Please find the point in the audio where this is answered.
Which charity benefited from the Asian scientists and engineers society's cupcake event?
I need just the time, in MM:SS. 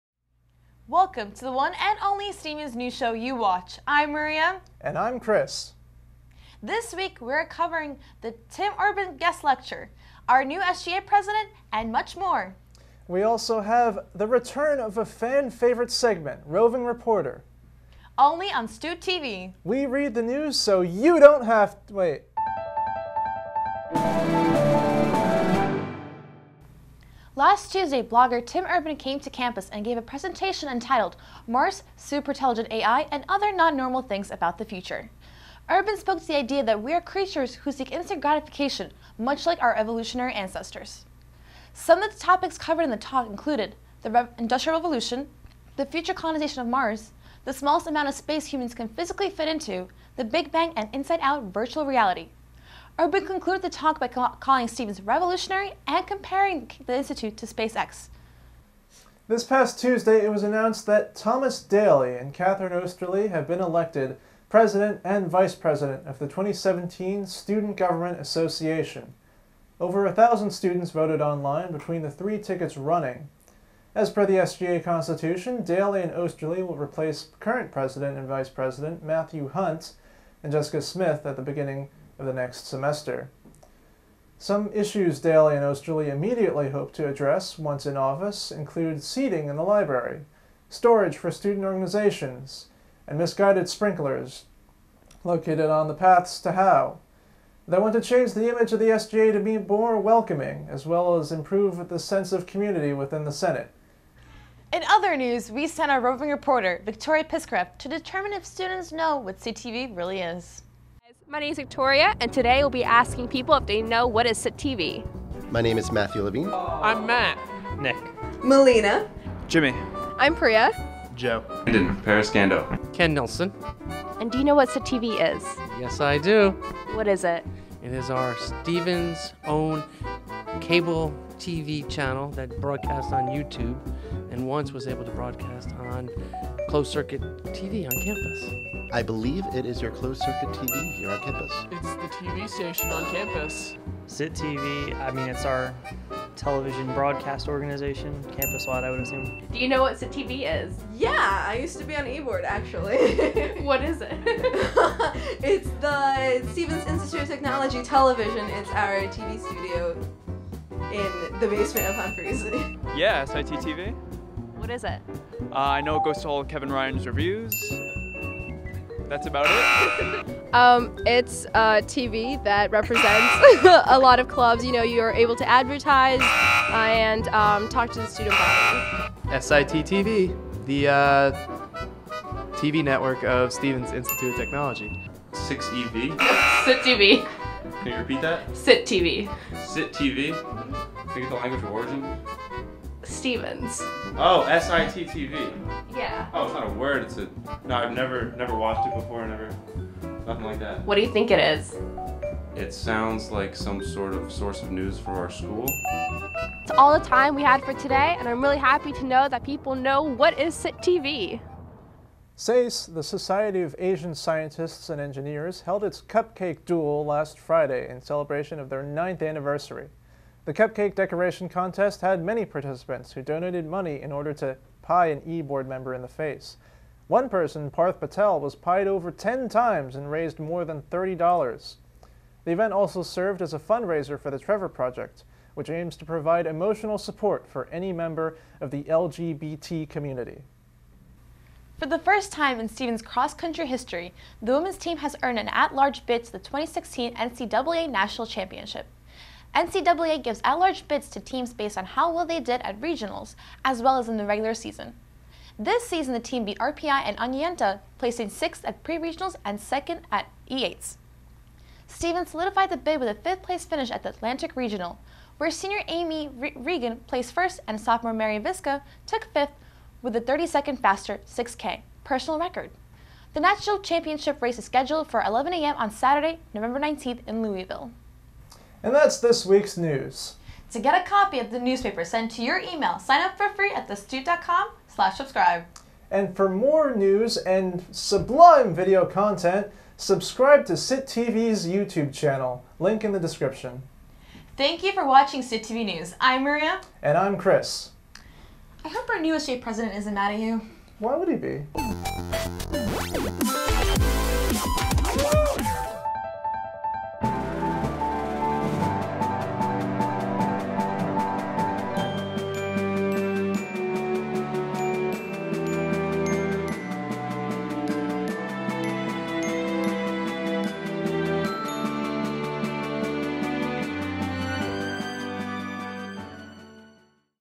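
03:54.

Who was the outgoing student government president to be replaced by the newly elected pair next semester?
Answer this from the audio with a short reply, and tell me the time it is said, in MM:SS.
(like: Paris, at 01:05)
Matthew Hunt, at 01:19.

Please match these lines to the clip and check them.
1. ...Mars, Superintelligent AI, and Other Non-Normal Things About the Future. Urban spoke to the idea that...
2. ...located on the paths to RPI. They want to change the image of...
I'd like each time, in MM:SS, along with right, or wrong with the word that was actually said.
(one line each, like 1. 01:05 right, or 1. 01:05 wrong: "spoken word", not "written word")
1. 00:31 right
2. 01:35 wrong: "Howe", not "RPI".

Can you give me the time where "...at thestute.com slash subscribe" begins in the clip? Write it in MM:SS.
04:43.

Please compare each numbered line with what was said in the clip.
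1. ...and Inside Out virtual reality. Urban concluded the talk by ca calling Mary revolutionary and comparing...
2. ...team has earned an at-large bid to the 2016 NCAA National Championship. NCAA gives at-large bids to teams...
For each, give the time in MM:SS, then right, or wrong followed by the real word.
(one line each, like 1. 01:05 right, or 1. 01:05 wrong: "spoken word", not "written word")
1. 00:50 wrong: "Stevens", not "Mary"
2. 04:04 right.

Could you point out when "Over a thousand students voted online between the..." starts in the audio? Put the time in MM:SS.
01:09.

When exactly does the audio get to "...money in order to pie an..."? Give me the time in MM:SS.
03:43.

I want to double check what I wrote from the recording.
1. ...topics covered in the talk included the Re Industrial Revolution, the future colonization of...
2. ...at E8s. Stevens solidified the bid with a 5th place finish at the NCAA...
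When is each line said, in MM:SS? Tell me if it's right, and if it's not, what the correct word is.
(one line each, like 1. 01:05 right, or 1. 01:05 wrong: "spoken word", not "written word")
1. 00:42 right
2. 04:20 wrong: "Atlantic", not "NCAA".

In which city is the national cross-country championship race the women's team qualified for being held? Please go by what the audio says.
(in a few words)
Louisville.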